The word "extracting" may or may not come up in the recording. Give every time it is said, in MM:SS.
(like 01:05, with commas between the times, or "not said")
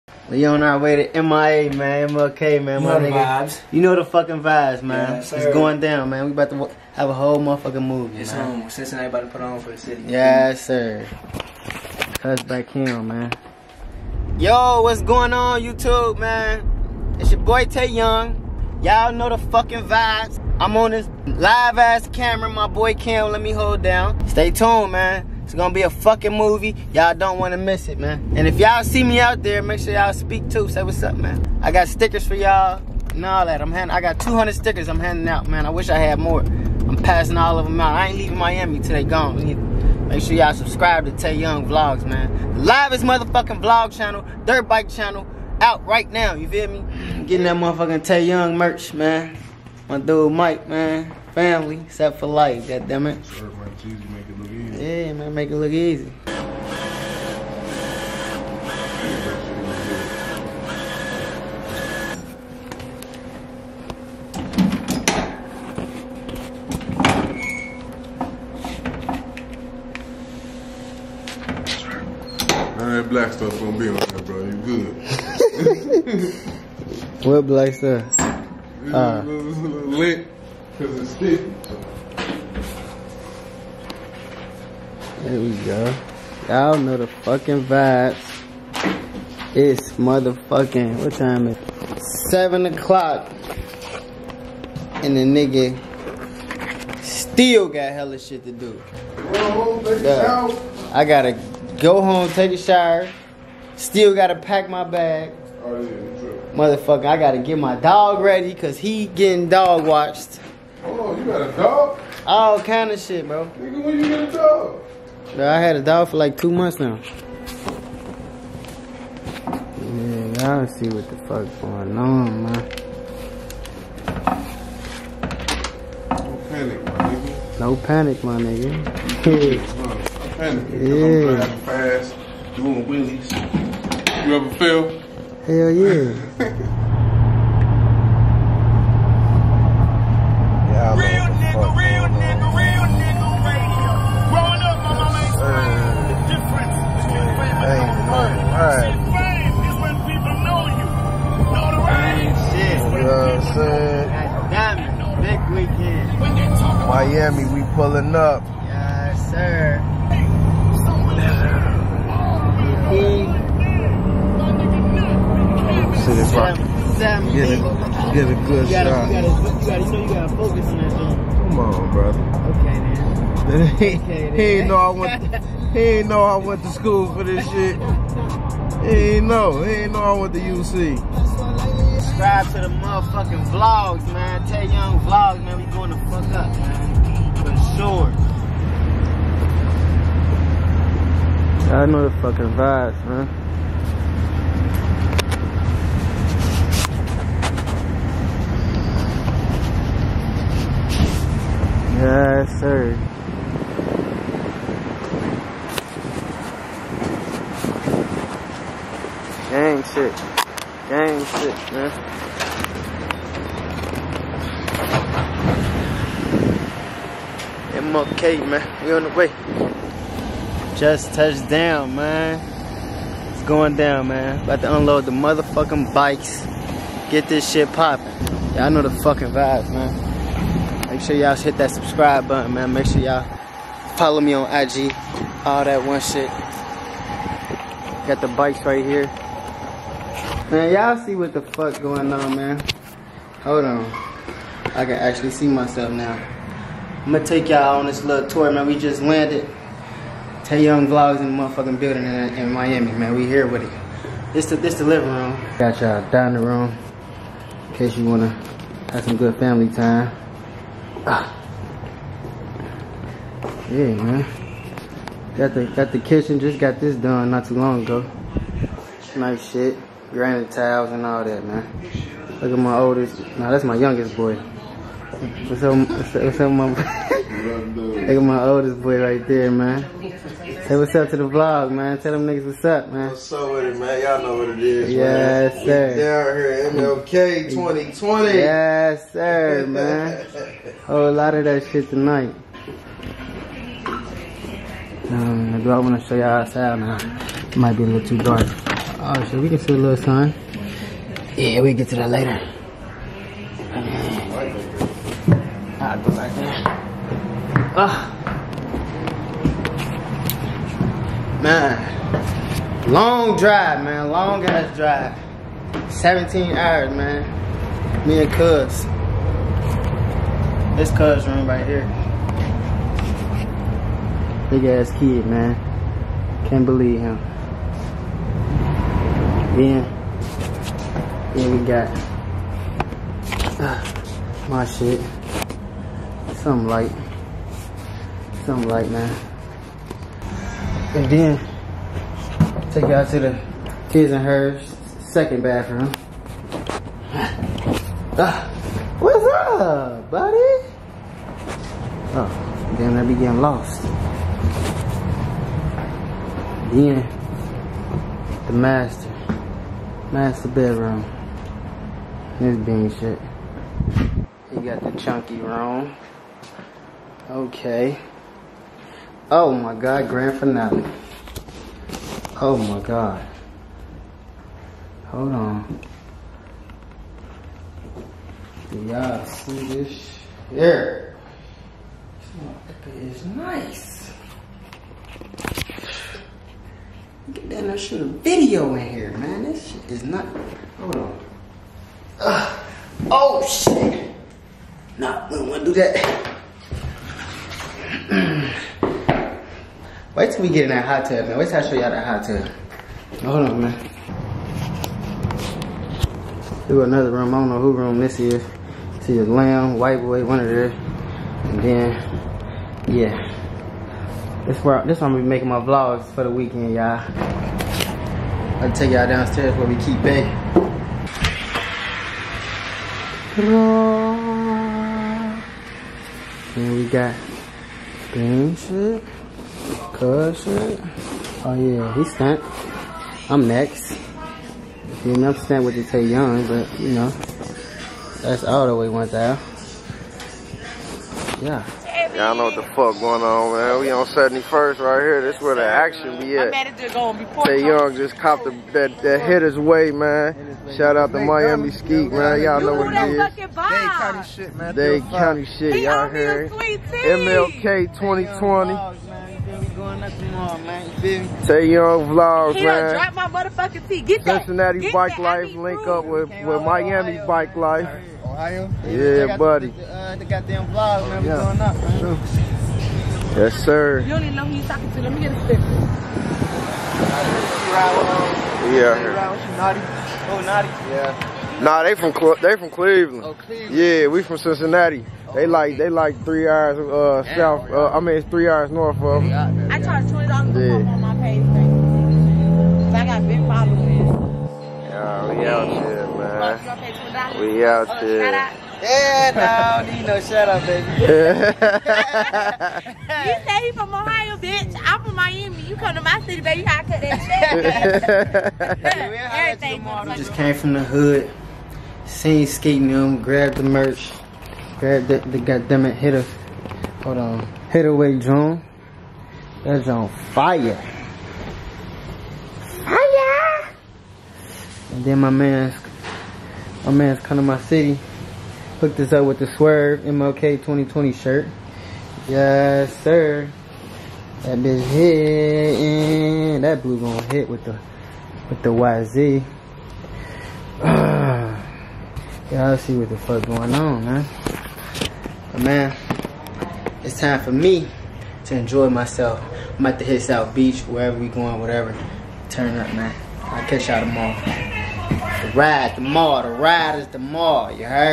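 not said.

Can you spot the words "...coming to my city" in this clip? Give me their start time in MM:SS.
08:47.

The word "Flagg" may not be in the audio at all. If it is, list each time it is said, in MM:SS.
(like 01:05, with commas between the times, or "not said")
not said.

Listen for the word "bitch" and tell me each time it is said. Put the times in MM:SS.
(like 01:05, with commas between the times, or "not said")
08:24, 08:54.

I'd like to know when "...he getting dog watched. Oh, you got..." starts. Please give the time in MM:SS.
01:48.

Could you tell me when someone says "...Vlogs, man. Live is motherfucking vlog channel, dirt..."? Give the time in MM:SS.
00:41.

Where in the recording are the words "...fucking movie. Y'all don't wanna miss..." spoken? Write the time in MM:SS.
00:25.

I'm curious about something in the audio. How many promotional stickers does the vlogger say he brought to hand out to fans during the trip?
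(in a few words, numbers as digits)
200.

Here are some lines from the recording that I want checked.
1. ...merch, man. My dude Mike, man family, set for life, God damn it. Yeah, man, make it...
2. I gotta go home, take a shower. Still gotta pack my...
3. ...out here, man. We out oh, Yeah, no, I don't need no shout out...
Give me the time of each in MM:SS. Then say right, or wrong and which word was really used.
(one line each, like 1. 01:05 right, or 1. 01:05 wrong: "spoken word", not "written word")
1. 00:48 right
2. 01:40 right
3. 08:15 right.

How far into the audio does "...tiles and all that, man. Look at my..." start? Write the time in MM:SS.
04:30.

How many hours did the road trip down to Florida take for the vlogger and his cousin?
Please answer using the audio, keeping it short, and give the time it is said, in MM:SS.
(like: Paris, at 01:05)
17 hours, at 05:15.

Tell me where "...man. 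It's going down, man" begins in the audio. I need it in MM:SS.
03:41.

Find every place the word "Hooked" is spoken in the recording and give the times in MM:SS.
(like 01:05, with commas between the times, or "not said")
08:48.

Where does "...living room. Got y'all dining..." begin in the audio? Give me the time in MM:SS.
04:14.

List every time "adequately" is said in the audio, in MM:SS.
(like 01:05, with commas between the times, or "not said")
not said.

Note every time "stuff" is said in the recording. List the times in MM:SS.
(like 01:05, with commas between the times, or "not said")
01:13, 01:17.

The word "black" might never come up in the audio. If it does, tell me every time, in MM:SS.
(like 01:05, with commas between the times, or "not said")
01:13, 01:17.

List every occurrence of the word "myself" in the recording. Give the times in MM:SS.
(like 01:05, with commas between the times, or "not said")
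04:05, 09:08.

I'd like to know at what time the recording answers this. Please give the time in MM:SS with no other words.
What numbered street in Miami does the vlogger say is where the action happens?
07:24.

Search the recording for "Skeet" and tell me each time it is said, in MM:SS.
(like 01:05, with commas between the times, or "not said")
07:31.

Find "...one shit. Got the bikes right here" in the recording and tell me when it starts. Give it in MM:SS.
03:55.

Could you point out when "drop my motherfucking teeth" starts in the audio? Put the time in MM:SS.
07:43.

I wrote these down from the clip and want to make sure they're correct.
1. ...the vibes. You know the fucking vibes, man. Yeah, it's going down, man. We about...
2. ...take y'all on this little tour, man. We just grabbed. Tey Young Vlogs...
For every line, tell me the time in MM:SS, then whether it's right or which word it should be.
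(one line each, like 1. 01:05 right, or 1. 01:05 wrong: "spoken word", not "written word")
1. 00:03 right
2. 04:07 wrong: "landed", not "grabbed".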